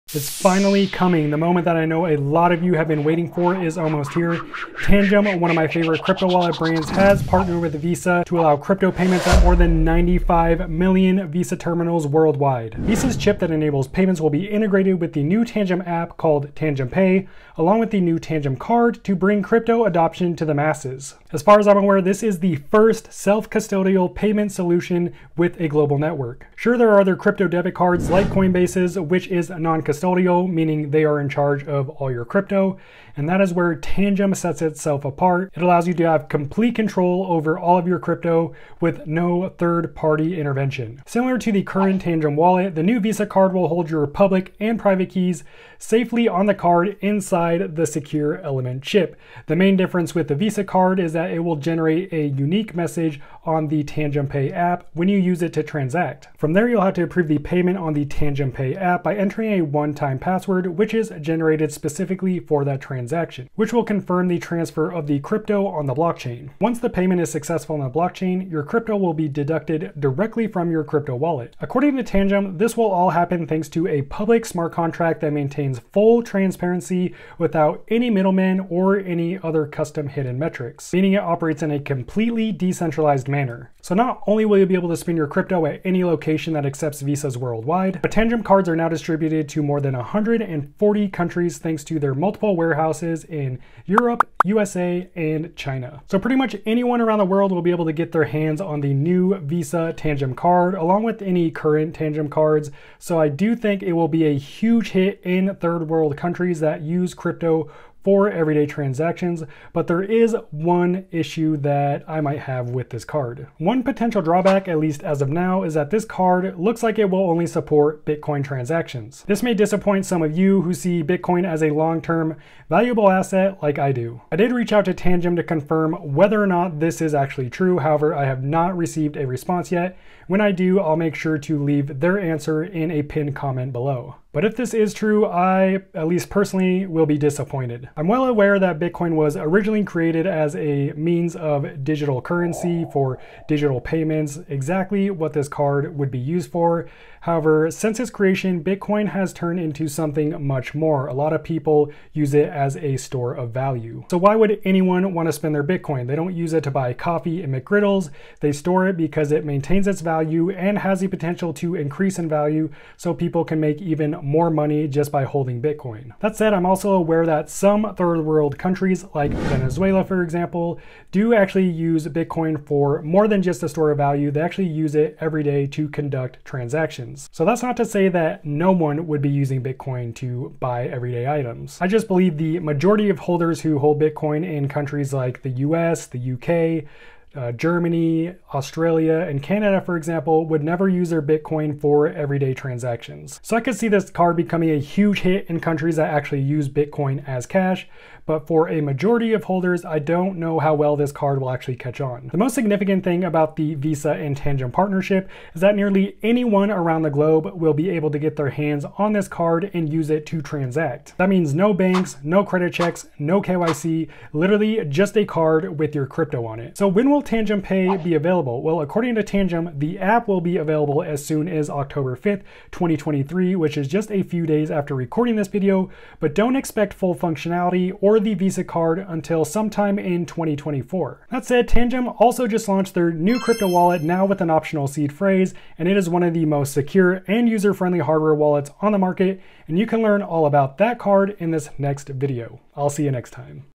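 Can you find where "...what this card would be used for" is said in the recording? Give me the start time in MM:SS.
02:25.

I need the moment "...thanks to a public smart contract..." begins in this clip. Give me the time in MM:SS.
01:13.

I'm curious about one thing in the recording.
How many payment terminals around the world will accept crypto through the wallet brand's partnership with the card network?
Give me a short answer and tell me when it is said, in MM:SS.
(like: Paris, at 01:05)
95 million, at 00:09.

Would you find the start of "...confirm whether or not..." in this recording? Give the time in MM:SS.
02:05.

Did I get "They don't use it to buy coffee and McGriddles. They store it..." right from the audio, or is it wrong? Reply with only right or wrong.
right.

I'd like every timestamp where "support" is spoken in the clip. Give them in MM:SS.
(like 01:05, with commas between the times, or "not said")
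01:57.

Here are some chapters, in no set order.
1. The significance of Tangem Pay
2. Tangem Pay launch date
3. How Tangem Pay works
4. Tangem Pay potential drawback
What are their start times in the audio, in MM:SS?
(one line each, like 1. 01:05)
1. 03:23
2. 03:37
3. 00:41
4. 01:50.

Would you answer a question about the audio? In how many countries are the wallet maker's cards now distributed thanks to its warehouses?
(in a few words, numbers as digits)
140.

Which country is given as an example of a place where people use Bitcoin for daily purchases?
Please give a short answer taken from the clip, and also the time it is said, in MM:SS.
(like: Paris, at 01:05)
Venezuela, at 02:49.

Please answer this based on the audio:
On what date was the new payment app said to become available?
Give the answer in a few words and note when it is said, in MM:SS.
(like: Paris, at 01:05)
October 5th, 2023, at 03:41.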